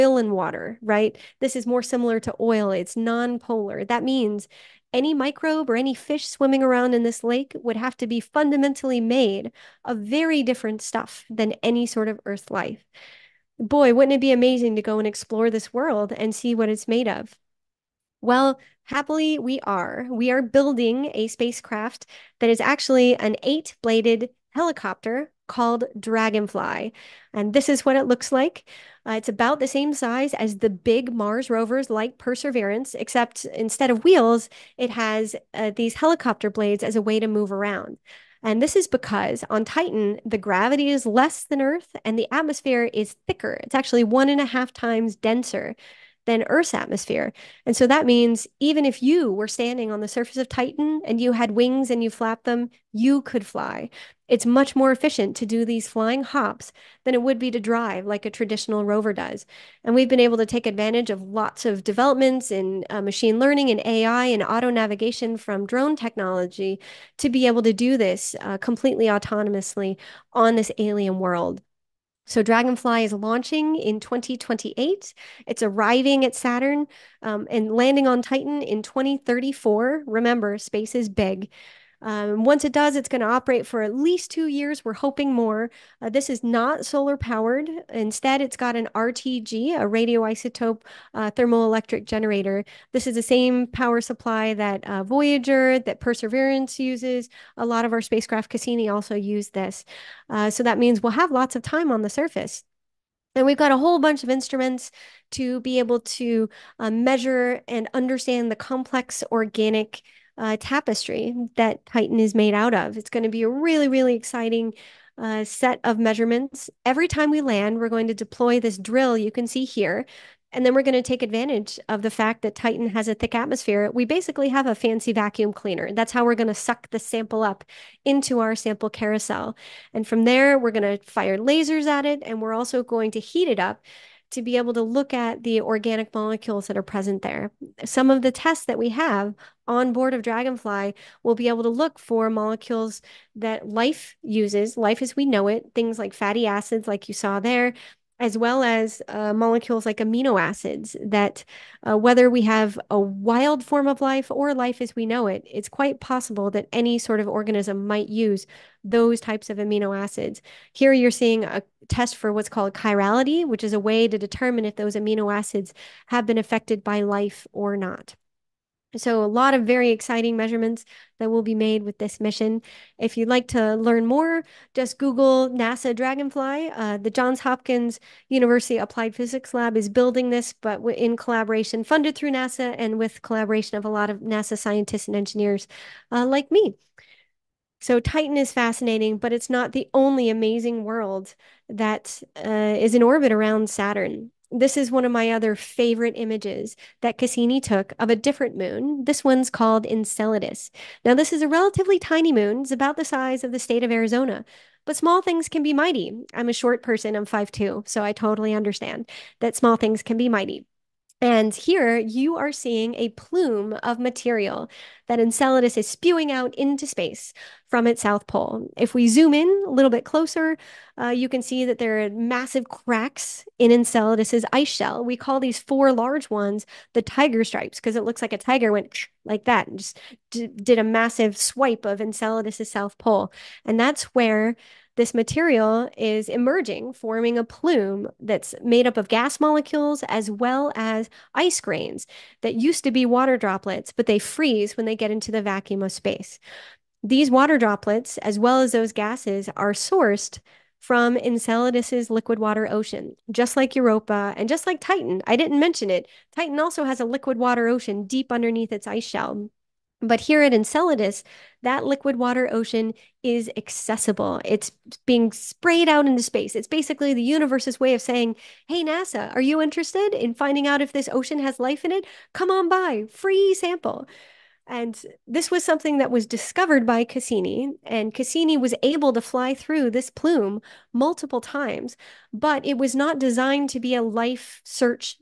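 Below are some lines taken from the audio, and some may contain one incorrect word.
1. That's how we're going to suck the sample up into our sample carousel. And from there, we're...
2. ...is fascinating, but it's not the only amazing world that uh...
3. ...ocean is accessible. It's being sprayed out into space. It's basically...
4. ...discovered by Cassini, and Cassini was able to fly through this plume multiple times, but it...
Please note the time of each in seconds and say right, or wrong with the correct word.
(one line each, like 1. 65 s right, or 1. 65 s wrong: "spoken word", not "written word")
1. 125 s right
2. 188 s right
3. 262 s right
4. 276 s right.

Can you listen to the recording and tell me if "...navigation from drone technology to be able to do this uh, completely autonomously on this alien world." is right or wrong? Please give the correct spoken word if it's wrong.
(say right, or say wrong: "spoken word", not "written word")
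right.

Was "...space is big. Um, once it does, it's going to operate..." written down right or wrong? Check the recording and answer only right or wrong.
right.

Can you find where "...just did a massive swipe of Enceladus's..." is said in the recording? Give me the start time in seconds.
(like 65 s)
229 s.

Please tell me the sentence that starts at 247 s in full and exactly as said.
These water droplets, as well as those gases, are sourced from Enceladus's liquid water ocean, just like Europa and just like Titan.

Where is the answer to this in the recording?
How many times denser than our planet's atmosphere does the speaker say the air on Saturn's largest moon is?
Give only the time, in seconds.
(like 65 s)
44 s.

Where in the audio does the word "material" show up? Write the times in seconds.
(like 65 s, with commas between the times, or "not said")
213 s, 235 s.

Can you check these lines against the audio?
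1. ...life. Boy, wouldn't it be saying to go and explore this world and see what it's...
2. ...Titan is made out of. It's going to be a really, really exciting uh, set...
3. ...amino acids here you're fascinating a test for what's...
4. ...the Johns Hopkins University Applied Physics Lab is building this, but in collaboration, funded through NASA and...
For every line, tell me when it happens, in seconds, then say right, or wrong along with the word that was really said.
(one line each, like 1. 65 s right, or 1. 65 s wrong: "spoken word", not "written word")
1. 12 s wrong: "amazing", not "saying"
2. 111 s right
3. 159 s wrong: "seeing", not "fascinating"
4. 176 s right.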